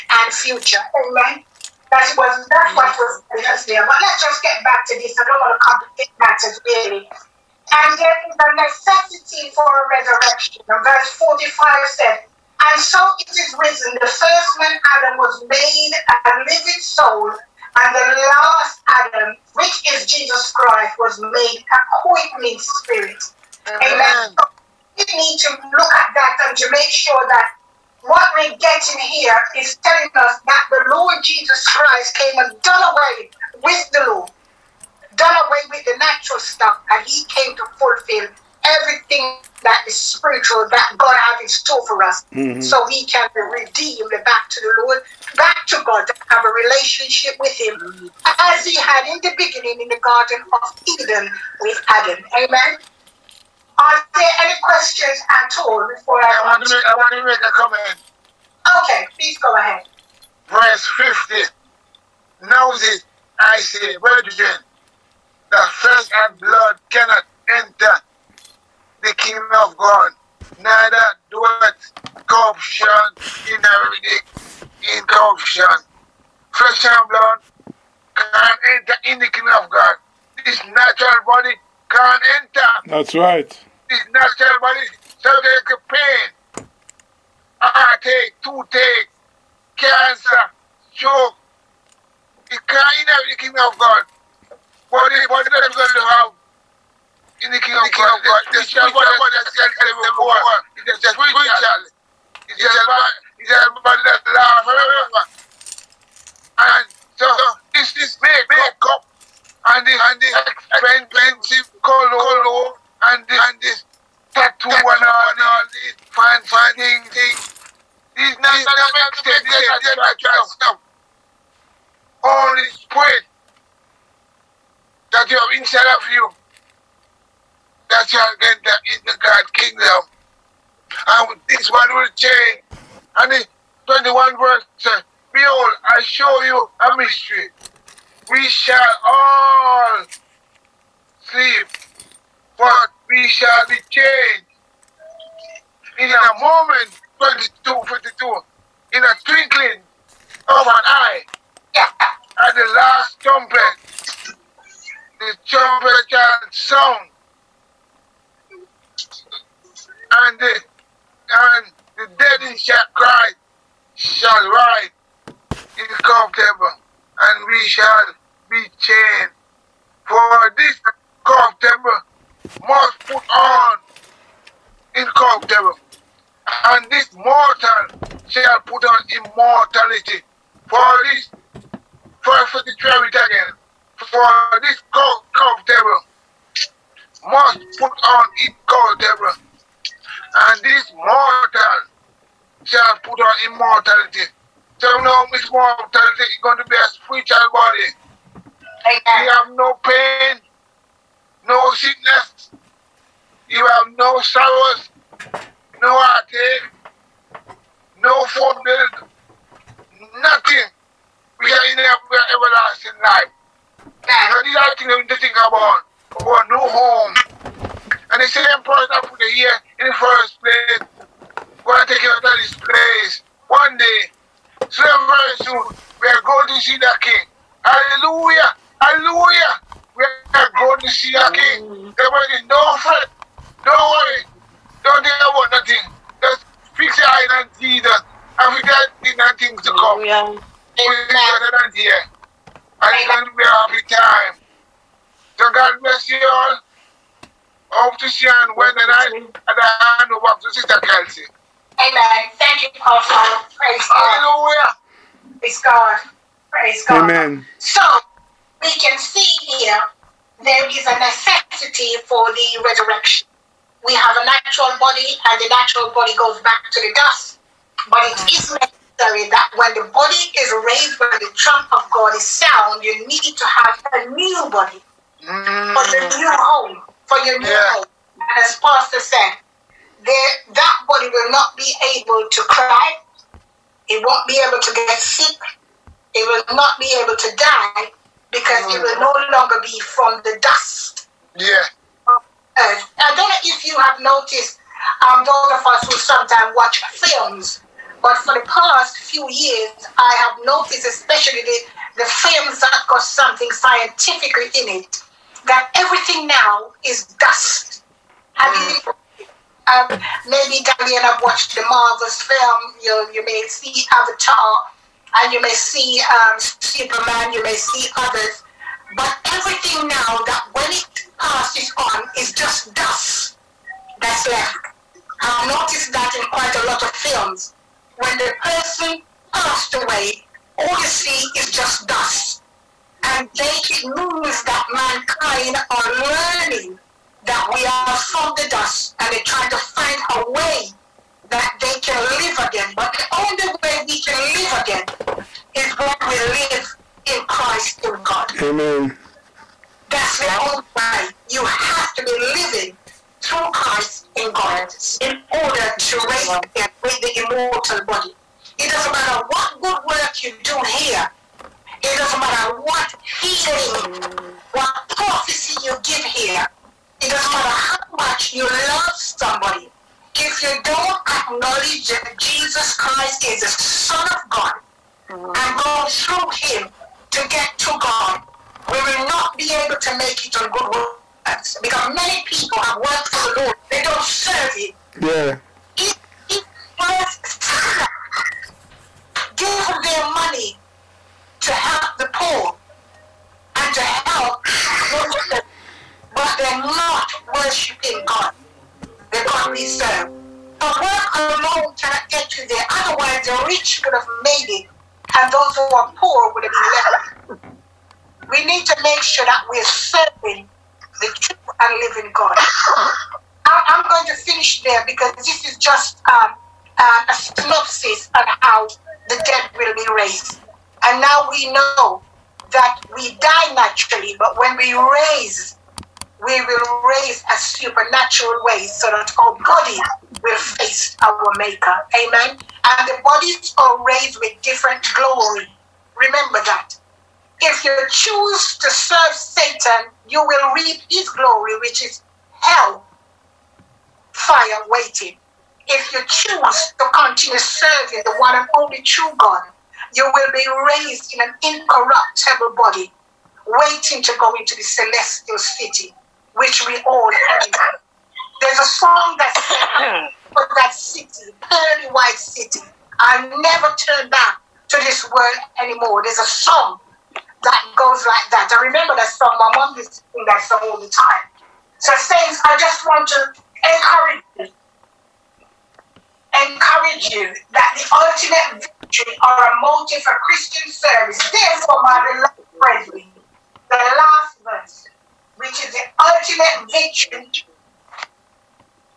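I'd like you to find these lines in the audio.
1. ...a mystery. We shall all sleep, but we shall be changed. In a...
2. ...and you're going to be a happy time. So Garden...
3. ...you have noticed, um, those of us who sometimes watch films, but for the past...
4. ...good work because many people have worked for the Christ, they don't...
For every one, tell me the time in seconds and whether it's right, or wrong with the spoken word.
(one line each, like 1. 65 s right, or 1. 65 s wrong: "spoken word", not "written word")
1. 136 s right
2. 242 s wrong: "God", not "Garden"
3. 293 s right
4. 380 s wrong: "Lord", not "Christ".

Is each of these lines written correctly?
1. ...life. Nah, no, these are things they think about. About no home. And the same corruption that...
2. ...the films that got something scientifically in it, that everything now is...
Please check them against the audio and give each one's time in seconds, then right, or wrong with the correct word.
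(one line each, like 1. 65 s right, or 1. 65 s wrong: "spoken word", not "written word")
1. 213 s wrong: "person", not "corruption"
2. 301 s right.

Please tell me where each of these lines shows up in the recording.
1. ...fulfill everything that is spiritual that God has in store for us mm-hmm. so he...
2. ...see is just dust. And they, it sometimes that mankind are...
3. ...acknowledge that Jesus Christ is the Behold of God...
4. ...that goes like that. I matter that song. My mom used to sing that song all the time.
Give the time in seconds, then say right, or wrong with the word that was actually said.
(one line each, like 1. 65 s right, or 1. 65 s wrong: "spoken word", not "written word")
1. 37 s right
2. 330 s wrong: "moves", not "sometimes"
3. 371 s wrong: "Son", not "Behold"
4. 467 s wrong: "remember", not "matter".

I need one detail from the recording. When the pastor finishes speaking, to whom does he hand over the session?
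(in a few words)
Sister Kelsey.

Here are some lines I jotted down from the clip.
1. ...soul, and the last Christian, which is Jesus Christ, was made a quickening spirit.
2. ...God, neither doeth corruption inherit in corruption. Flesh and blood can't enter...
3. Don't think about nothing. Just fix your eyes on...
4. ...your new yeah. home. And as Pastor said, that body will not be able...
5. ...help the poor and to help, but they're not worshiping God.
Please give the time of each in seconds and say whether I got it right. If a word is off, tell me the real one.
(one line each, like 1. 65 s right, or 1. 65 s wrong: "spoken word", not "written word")
1. 16 s wrong: "Adam", not "Christian"
2. 69 s right
3. 234 s right
4. 277 s right
5. 391 s right.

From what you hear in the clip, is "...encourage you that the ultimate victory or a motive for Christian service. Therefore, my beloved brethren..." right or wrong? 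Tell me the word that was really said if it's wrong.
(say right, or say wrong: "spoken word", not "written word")
right.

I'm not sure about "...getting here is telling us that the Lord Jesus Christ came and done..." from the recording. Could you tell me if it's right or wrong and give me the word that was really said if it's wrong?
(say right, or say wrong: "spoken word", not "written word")
right.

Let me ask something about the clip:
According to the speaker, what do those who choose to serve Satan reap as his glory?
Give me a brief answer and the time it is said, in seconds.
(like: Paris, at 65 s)
hell fire, at 442 s.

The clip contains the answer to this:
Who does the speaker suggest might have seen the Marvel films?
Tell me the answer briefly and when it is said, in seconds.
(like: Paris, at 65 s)
Daniel, at 310 s.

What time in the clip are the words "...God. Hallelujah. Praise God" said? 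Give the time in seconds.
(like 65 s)
253 s.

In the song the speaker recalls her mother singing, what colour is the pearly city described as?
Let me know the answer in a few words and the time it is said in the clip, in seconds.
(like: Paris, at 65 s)
white, at 461 s.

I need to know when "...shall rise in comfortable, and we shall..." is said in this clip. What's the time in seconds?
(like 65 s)
163 s.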